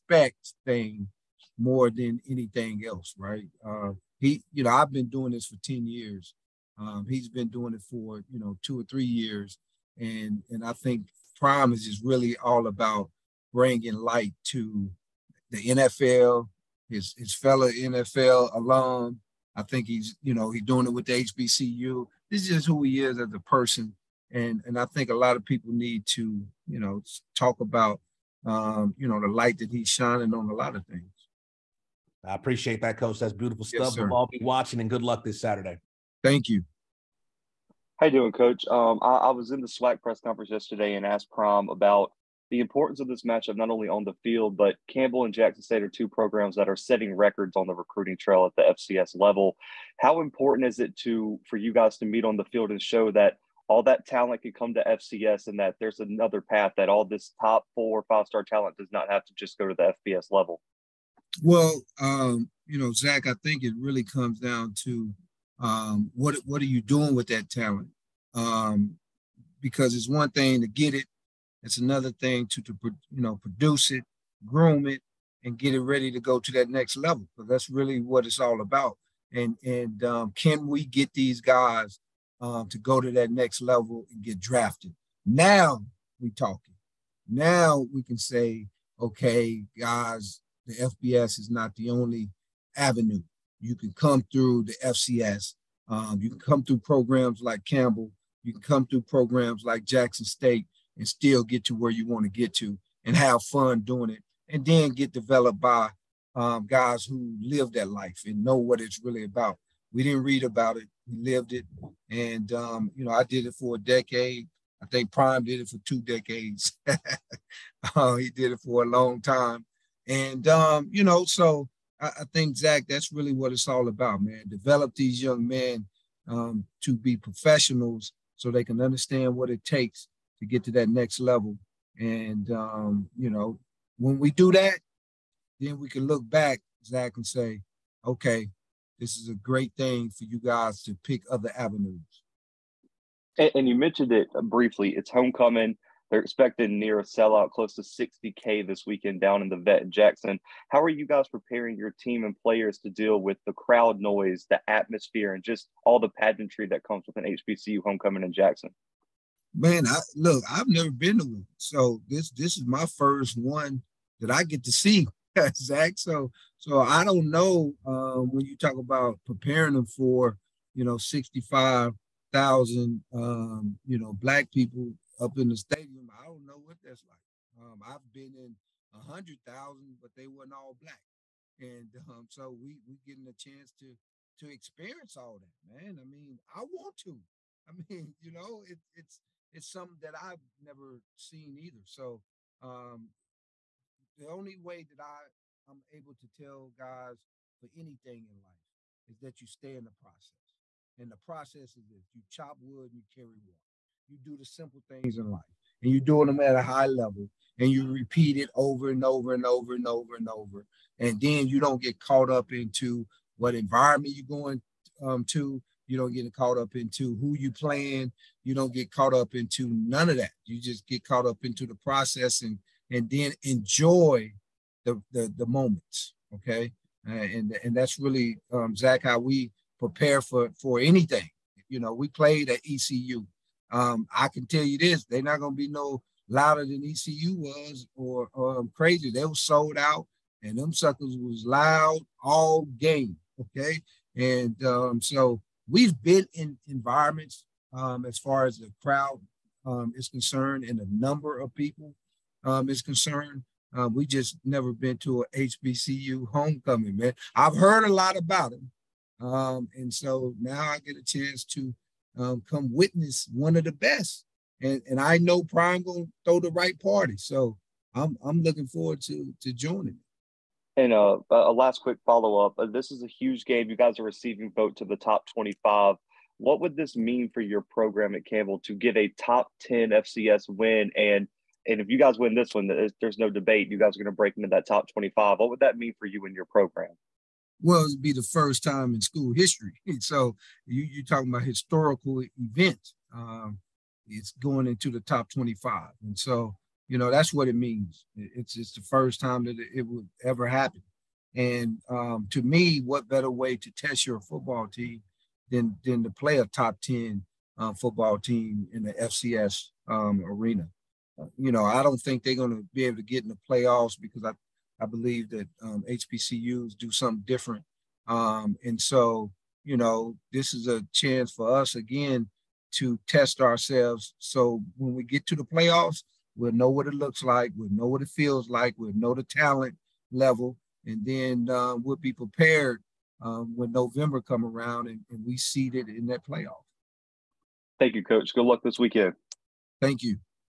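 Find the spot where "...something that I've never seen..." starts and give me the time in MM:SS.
03:09.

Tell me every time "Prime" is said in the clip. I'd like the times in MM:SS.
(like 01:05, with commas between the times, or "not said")
00:11, 00:41, 01:55, 04:25.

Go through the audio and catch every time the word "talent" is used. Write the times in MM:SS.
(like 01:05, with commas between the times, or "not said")
00:54, 00:58, 01:07, 05:29.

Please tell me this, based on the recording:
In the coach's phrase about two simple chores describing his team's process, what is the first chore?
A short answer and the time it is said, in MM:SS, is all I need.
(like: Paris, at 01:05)
Chop wood, at 03:22.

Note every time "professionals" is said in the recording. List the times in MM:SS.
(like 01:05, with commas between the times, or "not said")
02:07.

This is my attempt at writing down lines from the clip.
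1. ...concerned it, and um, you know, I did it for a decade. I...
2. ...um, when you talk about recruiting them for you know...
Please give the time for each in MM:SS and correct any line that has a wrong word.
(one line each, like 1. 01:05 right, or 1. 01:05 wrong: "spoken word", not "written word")
1. 01:51 wrong: "lived", not "concerned"
2. 02:47 wrong: "preparing", not "recruiting".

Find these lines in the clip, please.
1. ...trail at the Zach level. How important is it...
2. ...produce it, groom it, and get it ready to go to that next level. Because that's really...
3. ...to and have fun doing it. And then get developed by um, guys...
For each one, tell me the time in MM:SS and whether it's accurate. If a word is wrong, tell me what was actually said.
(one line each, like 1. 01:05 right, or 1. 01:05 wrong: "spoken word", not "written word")
1. 00:48 wrong: "FCS", not "Zach"
2. 01:13 right
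3. 01:42 right.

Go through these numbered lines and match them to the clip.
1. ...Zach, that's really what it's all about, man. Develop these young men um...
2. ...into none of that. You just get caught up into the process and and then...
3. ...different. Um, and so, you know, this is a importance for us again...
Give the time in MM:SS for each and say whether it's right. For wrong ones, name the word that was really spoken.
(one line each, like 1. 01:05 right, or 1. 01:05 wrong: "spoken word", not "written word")
1. 02:02 right
2. 03:39 right
3. 05:17 wrong: "chance", not "importance".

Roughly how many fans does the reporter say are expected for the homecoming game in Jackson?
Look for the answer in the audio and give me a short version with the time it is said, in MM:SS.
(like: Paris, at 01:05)
60K, at 02:27.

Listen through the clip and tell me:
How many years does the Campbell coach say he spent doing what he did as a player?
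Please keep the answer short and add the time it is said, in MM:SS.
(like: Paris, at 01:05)
10 years, at 00:05.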